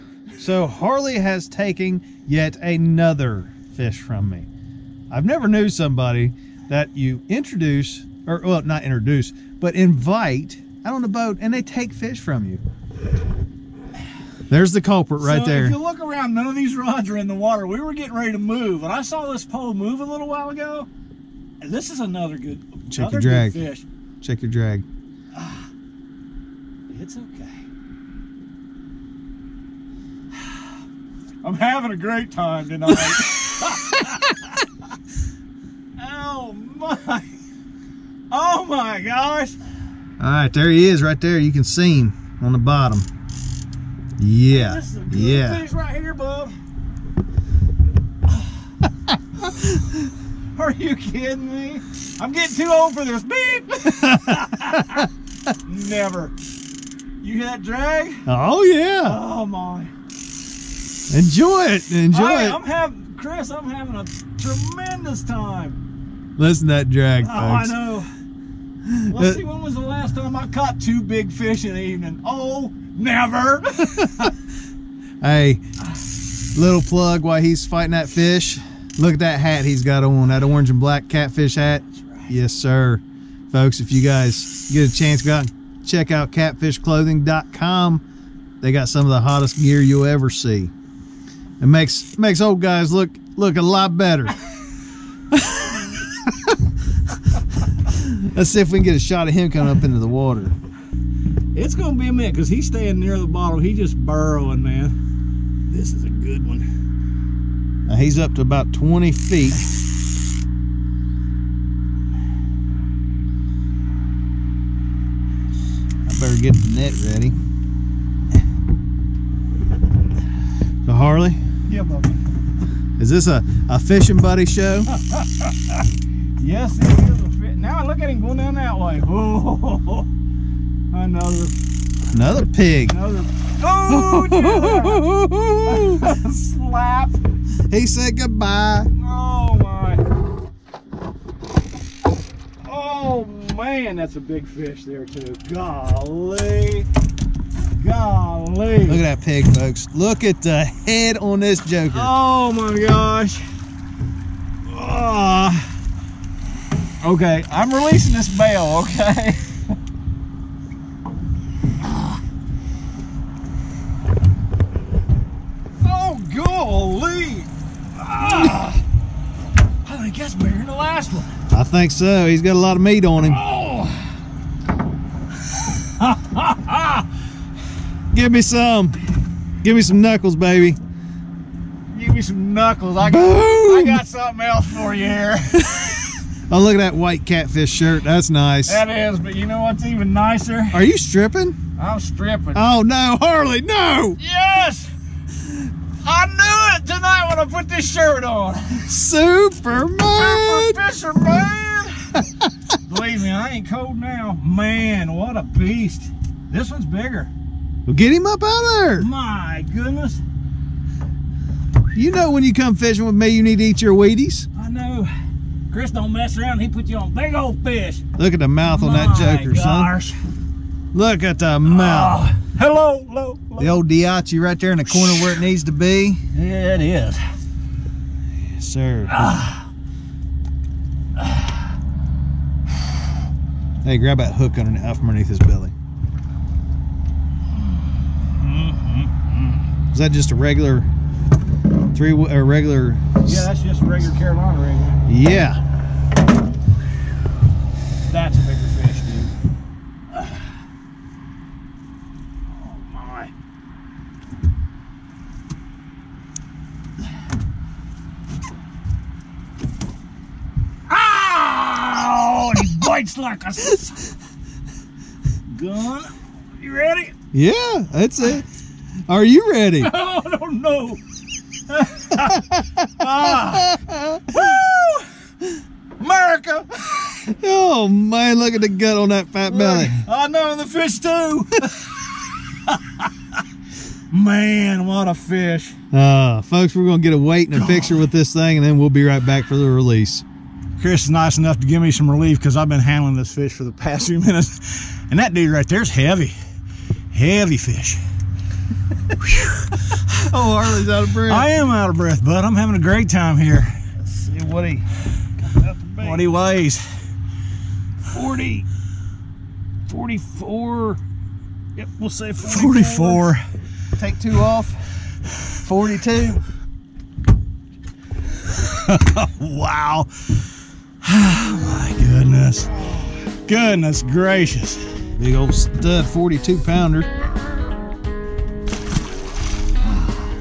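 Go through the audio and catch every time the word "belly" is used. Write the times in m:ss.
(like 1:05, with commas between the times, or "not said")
3:55, 4:39.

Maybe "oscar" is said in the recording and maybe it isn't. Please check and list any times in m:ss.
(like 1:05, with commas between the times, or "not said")
not said.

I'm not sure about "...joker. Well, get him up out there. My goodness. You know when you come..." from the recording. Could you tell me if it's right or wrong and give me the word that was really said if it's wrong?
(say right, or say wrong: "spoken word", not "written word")
wrong: "bigger", not "joker".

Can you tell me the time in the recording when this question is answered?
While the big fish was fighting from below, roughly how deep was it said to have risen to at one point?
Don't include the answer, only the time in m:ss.
1:48.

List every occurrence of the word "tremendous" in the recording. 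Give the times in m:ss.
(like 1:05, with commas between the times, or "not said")
1:04.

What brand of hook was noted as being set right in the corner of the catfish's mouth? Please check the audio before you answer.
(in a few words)
Daiichi.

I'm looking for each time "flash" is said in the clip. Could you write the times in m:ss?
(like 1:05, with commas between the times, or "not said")
not said.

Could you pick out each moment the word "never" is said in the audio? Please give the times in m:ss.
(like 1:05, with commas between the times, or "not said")
0:05, 0:55, 1:12.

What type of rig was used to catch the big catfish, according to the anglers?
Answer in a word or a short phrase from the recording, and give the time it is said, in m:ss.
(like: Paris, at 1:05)
Carolina rig, at 4:04.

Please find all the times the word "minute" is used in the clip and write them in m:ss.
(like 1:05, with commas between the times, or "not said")
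1:42, 4:54.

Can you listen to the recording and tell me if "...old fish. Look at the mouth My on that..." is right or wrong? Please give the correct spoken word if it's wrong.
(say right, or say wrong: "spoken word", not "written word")
right.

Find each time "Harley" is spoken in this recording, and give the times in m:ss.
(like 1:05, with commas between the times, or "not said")
0:00, 2:00, 3:13, 5:00.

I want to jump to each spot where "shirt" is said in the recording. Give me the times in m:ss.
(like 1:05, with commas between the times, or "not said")
3:07, 3:17.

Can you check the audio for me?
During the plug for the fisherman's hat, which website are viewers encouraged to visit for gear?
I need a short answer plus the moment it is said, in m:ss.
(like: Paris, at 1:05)
catfishclothing.com, at 1:26.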